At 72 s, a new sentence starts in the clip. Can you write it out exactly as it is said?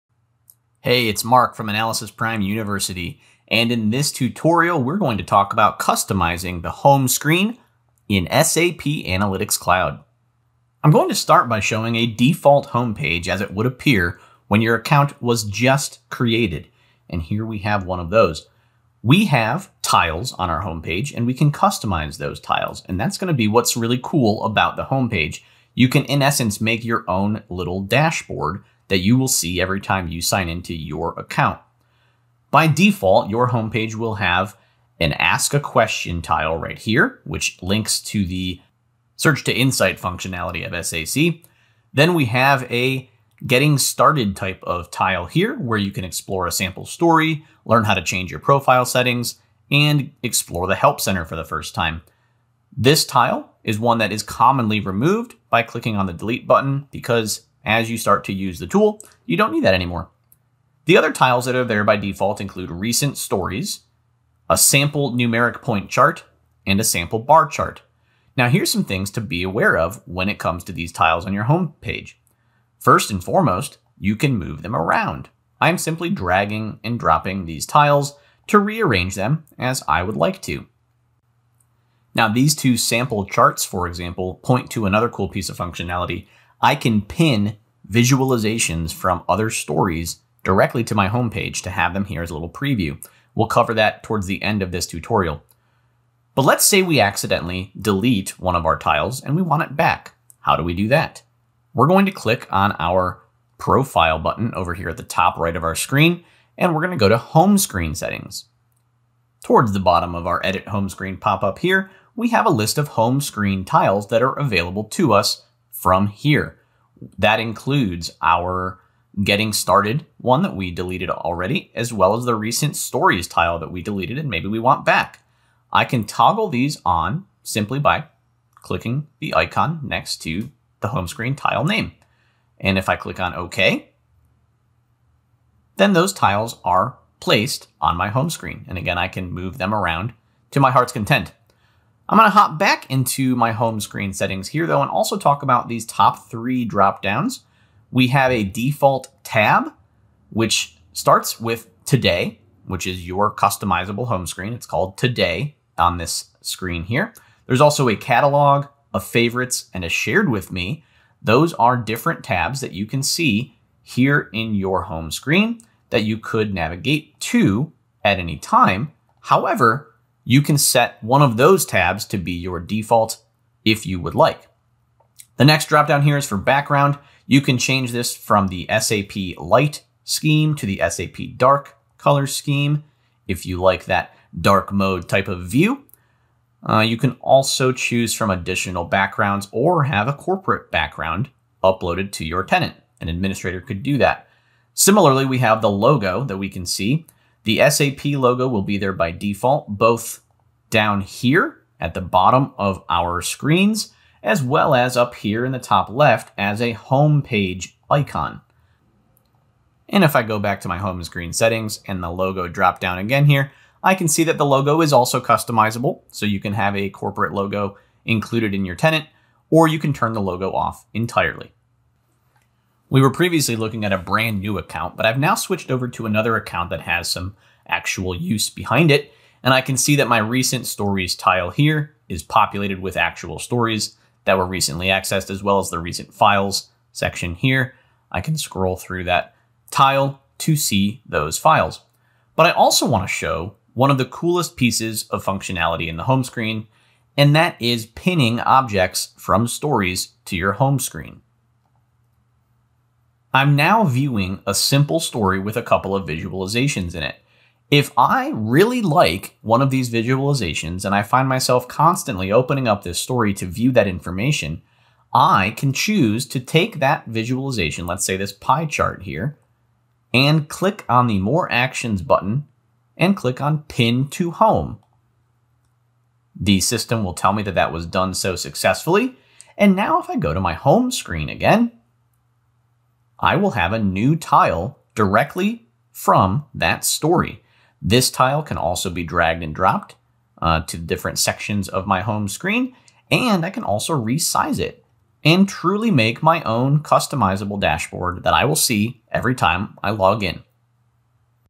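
First and foremost, you can move them around.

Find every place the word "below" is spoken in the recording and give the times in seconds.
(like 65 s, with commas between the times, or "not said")
not said.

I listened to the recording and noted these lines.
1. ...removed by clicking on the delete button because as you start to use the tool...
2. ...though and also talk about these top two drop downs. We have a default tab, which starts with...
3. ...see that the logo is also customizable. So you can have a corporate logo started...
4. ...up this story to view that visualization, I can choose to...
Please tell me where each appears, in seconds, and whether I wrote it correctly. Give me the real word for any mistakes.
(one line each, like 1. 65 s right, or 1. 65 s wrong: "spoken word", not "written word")
1. 54 s right
2. 144 s wrong: "three", not "two"
3. 214 s wrong: "included", not "started"
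4. 262 s wrong: "information", not "visualization".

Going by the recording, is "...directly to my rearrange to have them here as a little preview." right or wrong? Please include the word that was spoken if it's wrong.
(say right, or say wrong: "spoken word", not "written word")
wrong: "homepage", not "rearrange".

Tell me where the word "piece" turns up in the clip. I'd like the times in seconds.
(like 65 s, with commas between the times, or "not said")
85 s, 244 s.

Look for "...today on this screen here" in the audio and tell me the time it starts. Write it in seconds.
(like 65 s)
154 s.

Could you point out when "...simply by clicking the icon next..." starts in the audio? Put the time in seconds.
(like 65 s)
127 s.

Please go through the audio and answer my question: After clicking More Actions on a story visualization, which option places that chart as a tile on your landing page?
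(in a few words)
Pin to Home.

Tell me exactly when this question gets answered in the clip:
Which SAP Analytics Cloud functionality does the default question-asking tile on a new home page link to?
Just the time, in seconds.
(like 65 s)
39 s.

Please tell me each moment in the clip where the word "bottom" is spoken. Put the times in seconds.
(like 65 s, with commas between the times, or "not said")
109 s, 202 s.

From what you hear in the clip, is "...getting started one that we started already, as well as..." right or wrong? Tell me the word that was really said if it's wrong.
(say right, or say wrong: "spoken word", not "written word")
wrong: "deleted", not "started".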